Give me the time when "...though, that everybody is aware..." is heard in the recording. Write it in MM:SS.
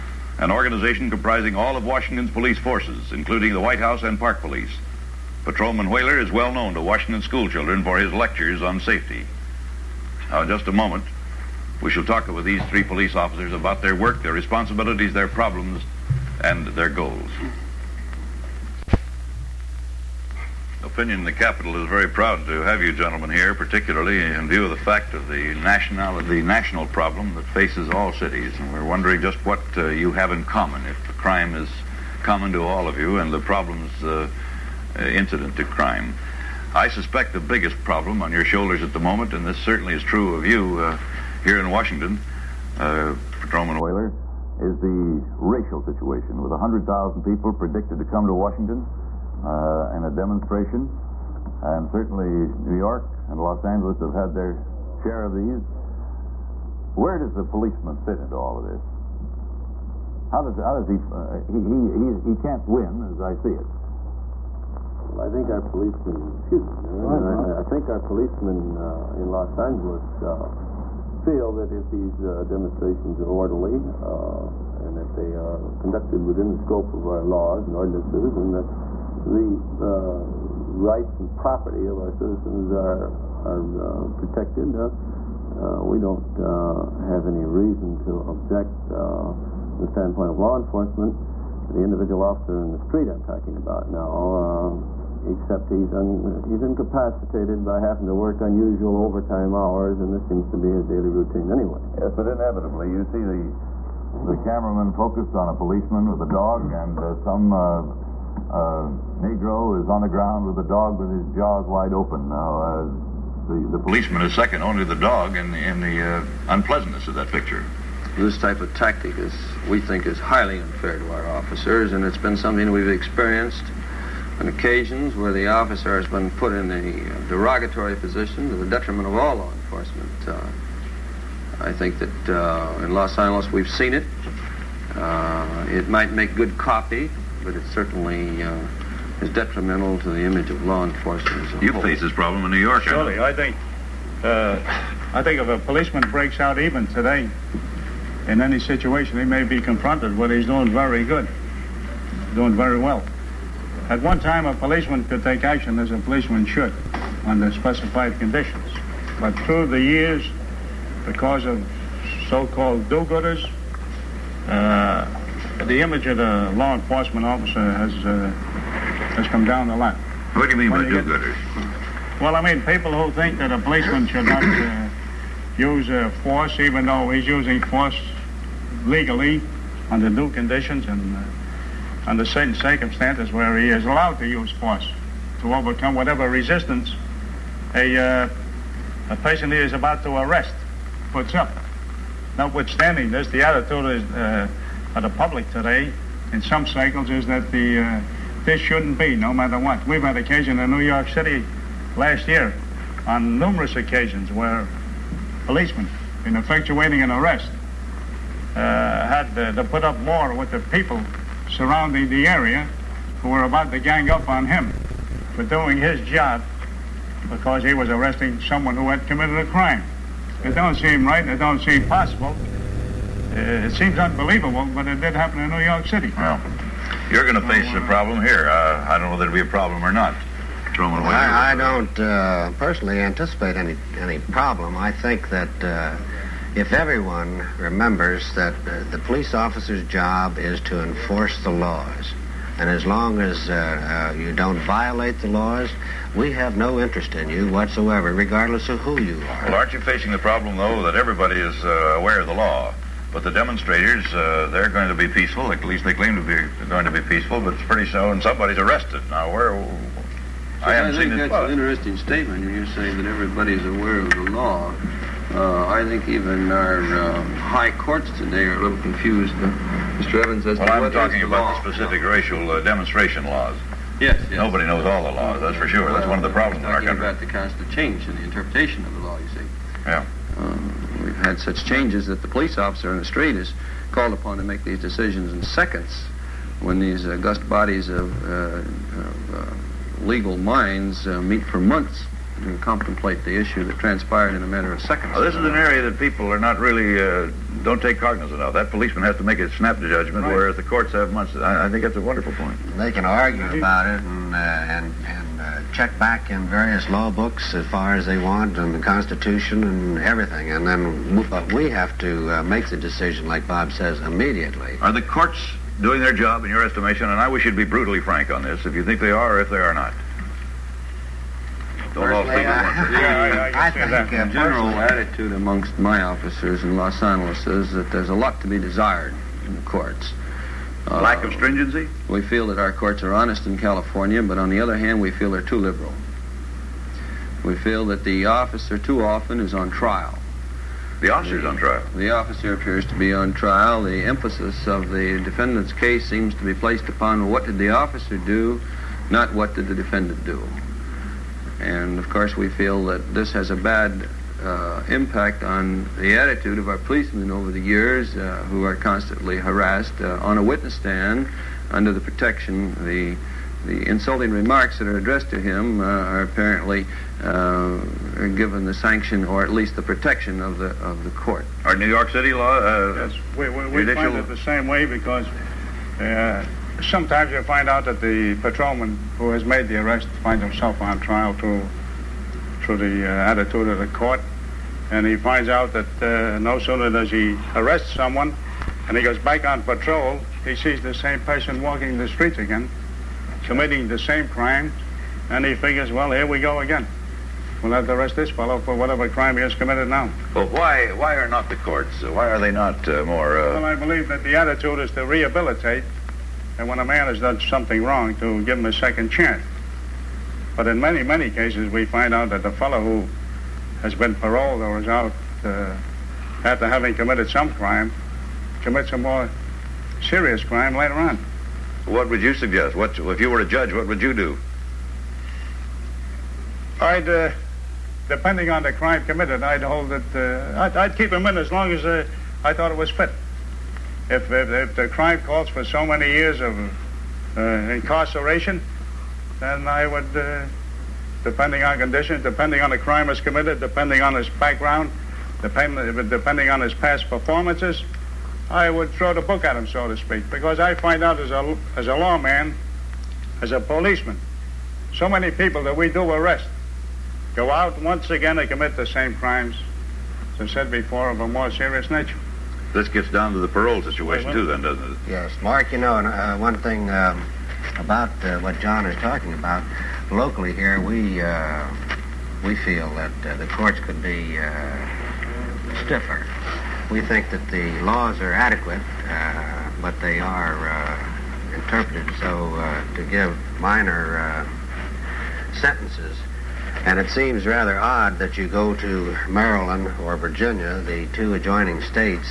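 04:10.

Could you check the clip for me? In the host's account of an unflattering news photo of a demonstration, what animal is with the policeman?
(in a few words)
A dog.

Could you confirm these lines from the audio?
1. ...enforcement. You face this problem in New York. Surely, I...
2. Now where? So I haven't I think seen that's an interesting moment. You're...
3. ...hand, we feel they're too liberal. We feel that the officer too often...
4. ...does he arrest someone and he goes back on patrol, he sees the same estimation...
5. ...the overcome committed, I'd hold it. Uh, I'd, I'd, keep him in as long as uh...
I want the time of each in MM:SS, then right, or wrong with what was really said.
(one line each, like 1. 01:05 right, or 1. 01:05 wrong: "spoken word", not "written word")
1. 02:20 right
2. 04:19 wrong: "statement", not "moment"
3. 05:34 right
4. 06:26 wrong: "person", not "estimation"
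5. 07:08 wrong: "crime", not "overcome".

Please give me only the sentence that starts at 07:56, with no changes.
We think that the laws are adequate, uh, but they are uh, interpreted so uh, to give minor sentences.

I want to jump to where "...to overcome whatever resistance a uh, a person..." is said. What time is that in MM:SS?
03:05.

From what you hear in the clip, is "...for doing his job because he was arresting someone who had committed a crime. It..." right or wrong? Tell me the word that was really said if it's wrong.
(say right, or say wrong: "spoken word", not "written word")
right.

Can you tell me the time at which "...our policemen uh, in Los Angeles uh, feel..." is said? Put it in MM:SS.
01:07.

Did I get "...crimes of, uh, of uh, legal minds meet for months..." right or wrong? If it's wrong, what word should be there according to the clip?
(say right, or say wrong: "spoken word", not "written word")
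wrong: "bodies", not "crimes".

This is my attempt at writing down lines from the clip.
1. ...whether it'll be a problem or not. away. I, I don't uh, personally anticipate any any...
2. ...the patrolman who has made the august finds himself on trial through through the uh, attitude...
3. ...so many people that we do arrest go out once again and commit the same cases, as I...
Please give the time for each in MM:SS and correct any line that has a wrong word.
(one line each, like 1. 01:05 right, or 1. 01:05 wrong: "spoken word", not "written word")
1. 03:49 right
2. 06:18 wrong: "arrest", not "august"
3. 07:34 wrong: "crimes", not "cases".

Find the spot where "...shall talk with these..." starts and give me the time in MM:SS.
00:11.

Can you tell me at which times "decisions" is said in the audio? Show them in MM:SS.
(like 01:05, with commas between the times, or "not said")
04:44, 05:12.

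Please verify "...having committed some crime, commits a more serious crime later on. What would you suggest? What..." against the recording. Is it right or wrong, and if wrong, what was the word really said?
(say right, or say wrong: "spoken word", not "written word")
right.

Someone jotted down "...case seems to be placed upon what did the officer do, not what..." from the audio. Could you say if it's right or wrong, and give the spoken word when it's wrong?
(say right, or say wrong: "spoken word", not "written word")
right.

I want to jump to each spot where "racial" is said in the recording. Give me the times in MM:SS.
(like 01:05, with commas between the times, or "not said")
00:45, 04:32.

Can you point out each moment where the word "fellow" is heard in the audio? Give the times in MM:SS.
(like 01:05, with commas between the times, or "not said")
06:38, 06:52.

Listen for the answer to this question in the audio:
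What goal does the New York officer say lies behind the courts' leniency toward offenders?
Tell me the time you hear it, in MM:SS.
06:44.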